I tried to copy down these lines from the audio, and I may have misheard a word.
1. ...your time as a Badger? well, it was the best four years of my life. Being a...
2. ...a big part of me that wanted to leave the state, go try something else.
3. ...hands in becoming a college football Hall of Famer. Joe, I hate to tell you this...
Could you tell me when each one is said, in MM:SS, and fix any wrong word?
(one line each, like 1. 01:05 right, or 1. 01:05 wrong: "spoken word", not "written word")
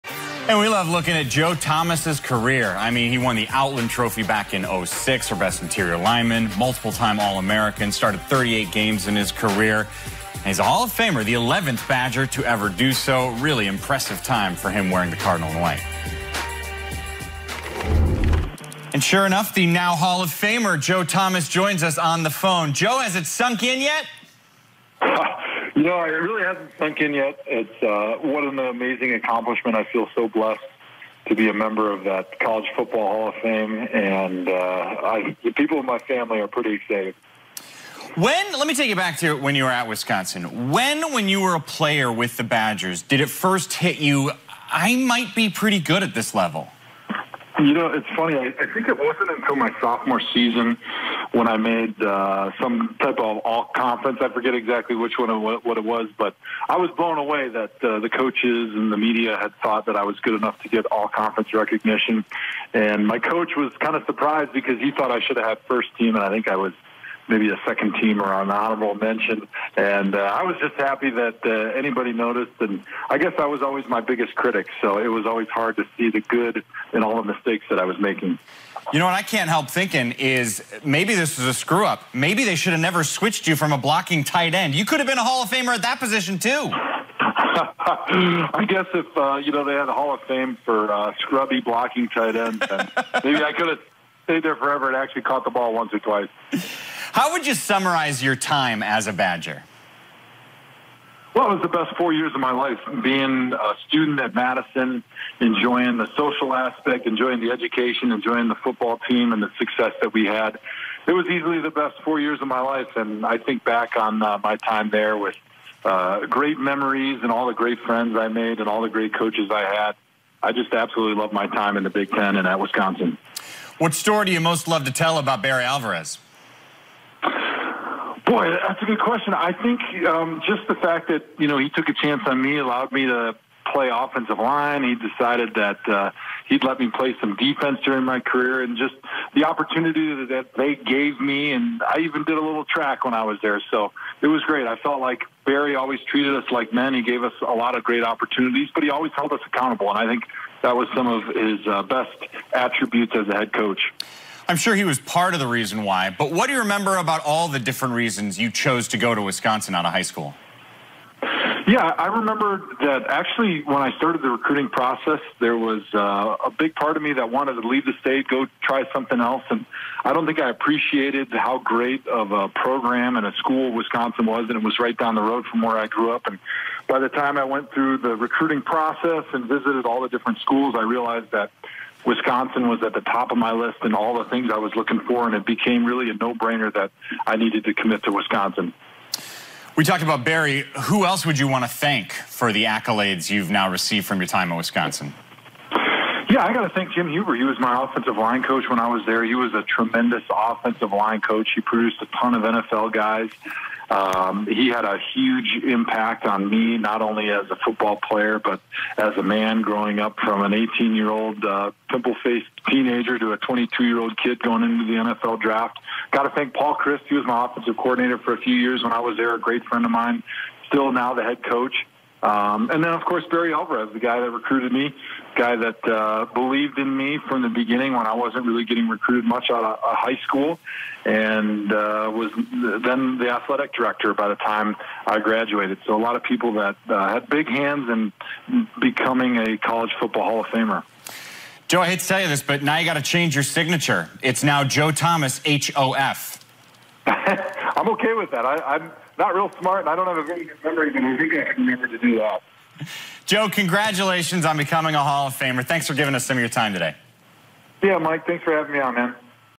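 1. 01:38 right
2. 02:46 right
3. 03:57 right.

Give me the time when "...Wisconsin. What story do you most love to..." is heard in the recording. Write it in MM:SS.
02:02.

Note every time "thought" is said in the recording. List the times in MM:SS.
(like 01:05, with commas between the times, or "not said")
00:59, 01:04.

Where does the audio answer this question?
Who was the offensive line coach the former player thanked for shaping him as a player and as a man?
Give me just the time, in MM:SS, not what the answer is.
03:16.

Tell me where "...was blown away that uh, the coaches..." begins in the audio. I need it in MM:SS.
00:56.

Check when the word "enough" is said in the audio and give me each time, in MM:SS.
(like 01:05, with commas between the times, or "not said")
00:19, 01:00.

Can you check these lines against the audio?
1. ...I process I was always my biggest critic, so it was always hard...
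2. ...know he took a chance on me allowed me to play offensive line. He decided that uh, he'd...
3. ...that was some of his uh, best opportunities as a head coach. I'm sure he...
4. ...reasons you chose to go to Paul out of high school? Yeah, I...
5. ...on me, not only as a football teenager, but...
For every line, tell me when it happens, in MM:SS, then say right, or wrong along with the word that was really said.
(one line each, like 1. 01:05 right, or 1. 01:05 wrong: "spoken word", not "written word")
1. 01:13 wrong: "guess", not "process"
2. 02:11 right
3. 02:30 wrong: "attributes", not "opportunities"
4. 02:37 wrong: "Wisconsin", not "Paul"
5. 03:26 wrong: "player", not "teenager".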